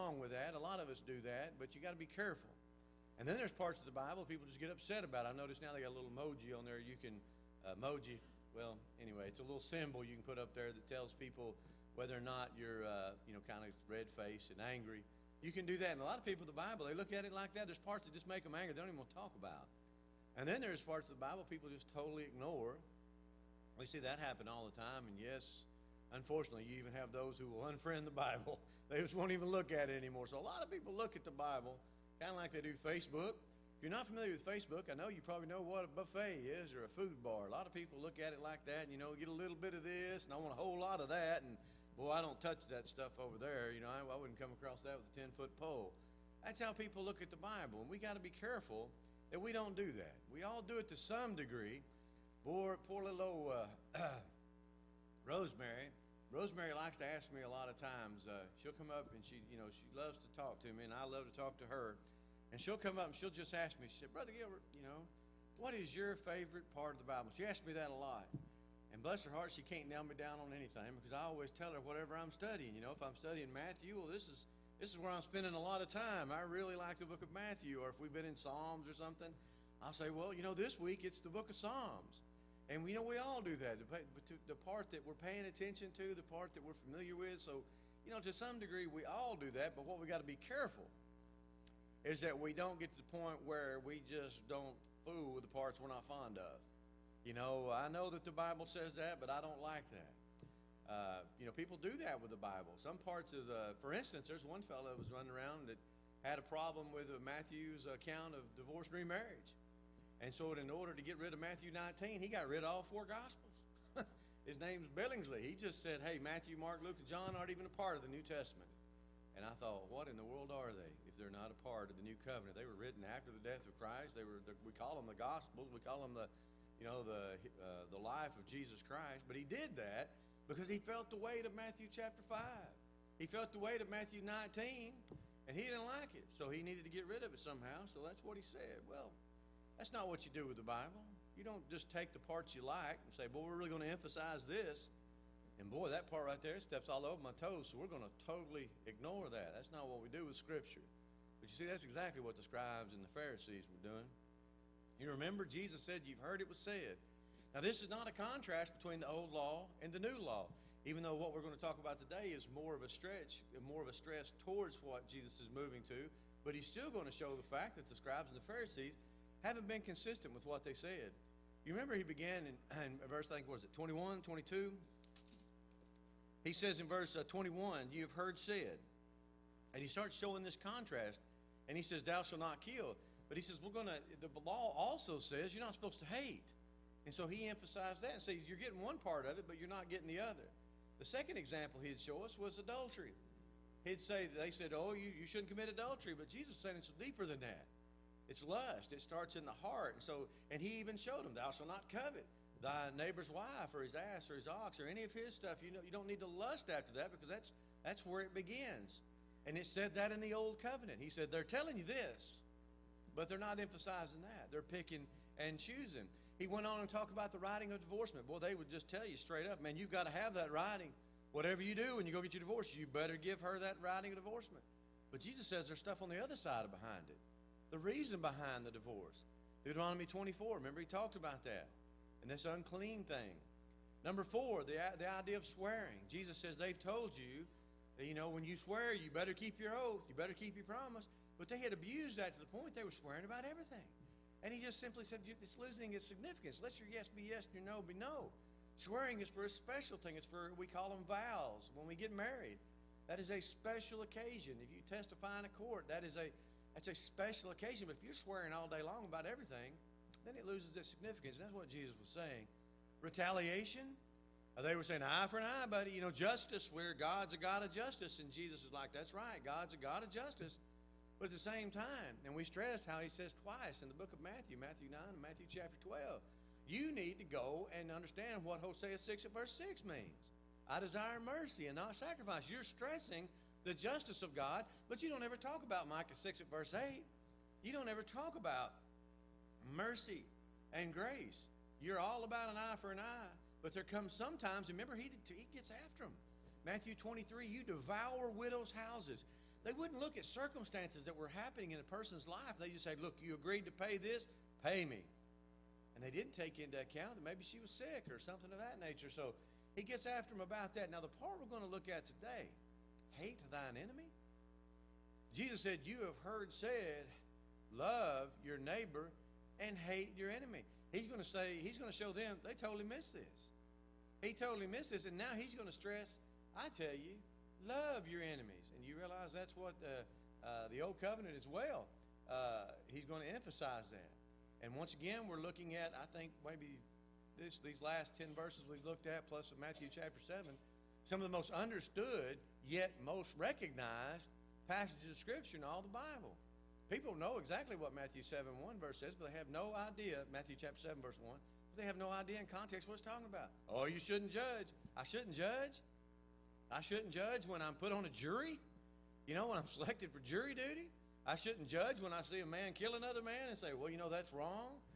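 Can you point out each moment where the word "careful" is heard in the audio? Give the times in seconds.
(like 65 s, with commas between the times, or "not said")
2 s, 48 s, 90 s.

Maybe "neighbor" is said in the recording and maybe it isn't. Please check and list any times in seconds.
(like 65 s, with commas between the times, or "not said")
202 s, 318 s.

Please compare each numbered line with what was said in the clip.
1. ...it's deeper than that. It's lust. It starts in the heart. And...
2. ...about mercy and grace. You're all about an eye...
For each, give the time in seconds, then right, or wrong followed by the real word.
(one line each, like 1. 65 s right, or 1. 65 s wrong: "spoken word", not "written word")
1. 196 s right
2. 288 s right.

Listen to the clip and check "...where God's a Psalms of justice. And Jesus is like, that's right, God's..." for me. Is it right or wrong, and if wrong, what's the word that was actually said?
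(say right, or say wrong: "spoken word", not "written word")
wrong: "God", not "Psalms".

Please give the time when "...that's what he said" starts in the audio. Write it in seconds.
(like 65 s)
138 s.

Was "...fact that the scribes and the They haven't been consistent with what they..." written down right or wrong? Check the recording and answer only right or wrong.
wrong.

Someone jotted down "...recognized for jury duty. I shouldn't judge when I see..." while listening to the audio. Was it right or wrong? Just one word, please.
wrong.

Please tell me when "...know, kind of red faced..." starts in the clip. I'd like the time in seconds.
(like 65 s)
13 s.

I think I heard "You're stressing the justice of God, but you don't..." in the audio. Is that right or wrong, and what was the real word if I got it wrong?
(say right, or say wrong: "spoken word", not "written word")
right.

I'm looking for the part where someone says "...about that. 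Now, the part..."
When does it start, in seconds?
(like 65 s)
310 s.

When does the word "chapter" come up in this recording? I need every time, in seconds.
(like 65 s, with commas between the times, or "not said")
131 s, 275 s, 339 s, 350 s.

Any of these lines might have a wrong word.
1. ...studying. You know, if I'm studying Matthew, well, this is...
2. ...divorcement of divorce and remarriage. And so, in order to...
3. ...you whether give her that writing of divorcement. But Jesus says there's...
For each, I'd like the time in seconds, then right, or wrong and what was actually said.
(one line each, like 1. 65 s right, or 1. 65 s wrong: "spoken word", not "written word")
1. 72 s right
2. 107 s wrong: "account", not "divorcement"
3. 222 s wrong: "better", not "whether".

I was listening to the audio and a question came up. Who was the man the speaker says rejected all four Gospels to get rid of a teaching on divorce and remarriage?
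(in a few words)
Billingsley.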